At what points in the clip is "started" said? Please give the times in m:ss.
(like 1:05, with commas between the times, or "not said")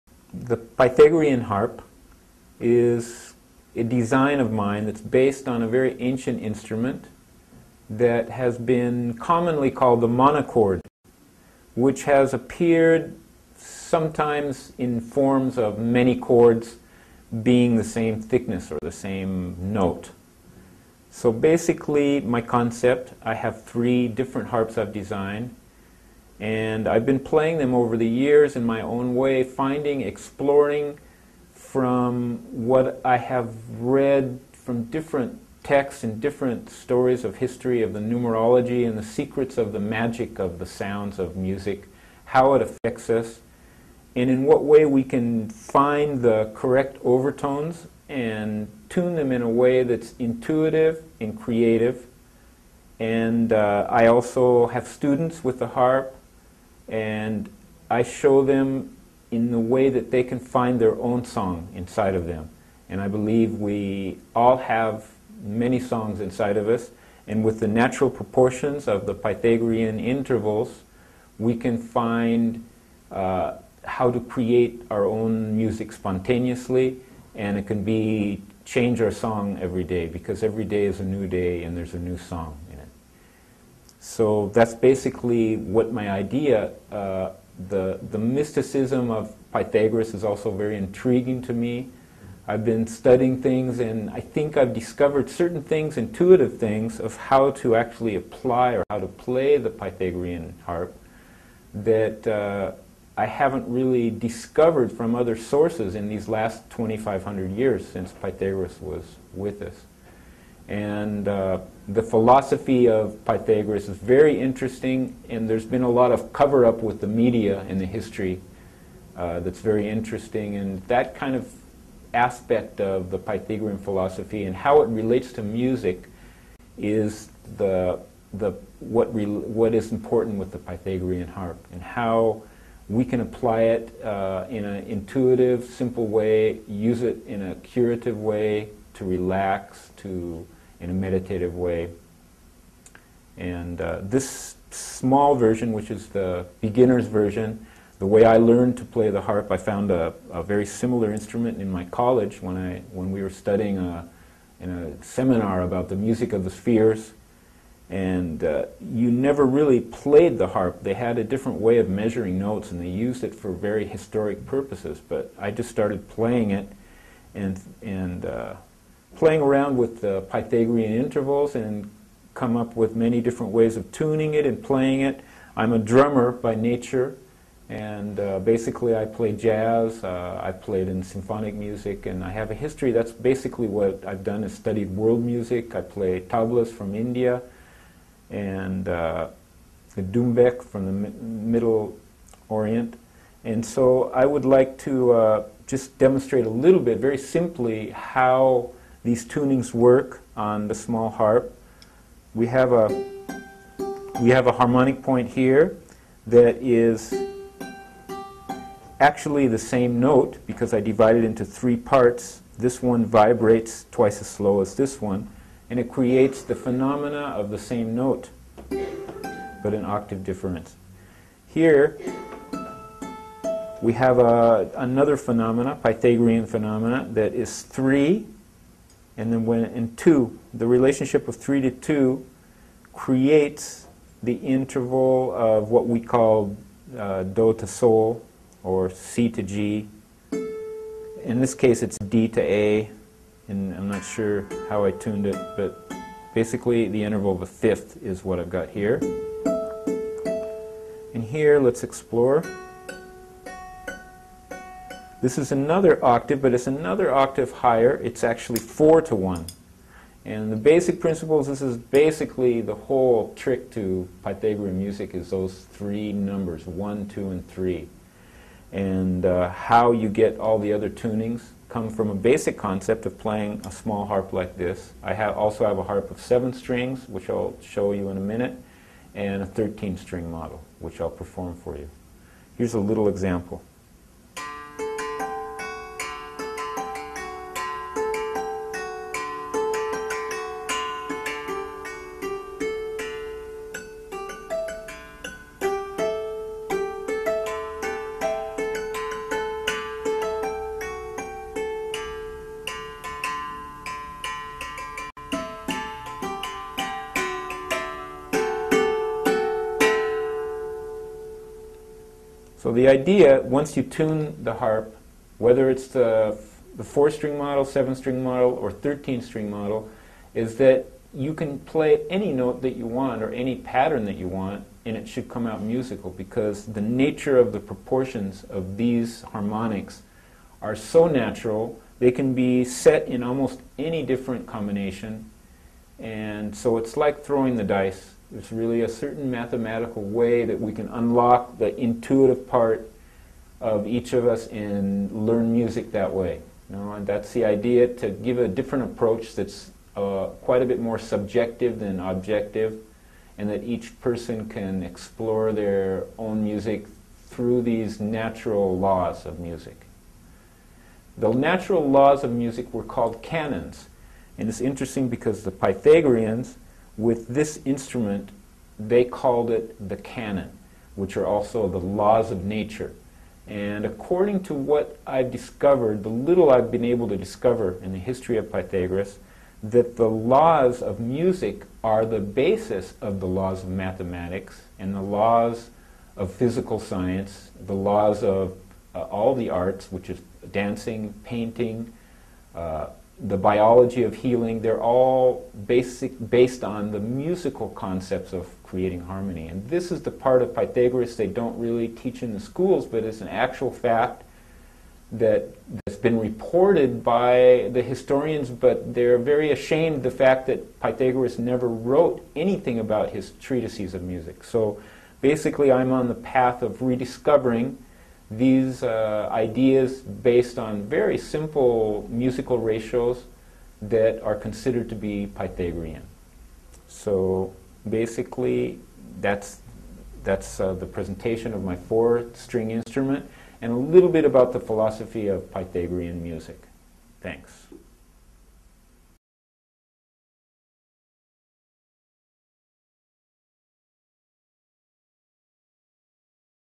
2:45.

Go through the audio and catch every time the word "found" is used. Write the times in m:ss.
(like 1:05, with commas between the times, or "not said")
2:29.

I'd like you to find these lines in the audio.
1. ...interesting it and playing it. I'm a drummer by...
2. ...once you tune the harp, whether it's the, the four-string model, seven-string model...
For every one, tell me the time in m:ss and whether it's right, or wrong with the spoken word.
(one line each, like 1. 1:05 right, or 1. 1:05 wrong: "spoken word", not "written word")
1. 2:53 wrong: "tuning", not "interesting"
2. 5:13 right.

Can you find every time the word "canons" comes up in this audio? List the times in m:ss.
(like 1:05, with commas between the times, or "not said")
6:03, 6:09.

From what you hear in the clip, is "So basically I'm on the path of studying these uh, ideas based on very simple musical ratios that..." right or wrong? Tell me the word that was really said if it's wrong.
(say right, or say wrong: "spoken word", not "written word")
wrong: "rediscovering", not "studying".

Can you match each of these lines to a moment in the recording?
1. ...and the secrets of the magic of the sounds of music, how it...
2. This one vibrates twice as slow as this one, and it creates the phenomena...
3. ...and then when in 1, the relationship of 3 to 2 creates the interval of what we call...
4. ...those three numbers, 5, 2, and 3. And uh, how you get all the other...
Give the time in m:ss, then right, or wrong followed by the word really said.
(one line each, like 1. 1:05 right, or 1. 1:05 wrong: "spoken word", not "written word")
1. 0:38 right
2. 3:32 right
3. 3:49 wrong: "2", not "1"
4. 4:25 wrong: "1", not "5".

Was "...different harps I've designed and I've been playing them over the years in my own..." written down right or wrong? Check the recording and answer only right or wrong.
right.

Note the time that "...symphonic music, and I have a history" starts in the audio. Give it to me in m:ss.
3:01.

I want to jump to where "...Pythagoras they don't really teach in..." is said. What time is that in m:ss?
6:40.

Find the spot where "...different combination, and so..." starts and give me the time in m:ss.
5:34.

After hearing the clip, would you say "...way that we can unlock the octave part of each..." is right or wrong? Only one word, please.
wrong.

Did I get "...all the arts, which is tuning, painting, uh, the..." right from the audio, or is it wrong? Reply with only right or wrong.
wrong.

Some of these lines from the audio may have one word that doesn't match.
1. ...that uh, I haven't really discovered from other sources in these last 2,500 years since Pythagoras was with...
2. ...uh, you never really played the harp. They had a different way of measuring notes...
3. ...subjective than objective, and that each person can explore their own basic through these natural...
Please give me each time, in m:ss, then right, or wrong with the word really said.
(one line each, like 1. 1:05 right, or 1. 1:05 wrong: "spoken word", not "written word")
1. 1:41 right
2. 2:38 right
3. 5:50 wrong: "music", not "basic".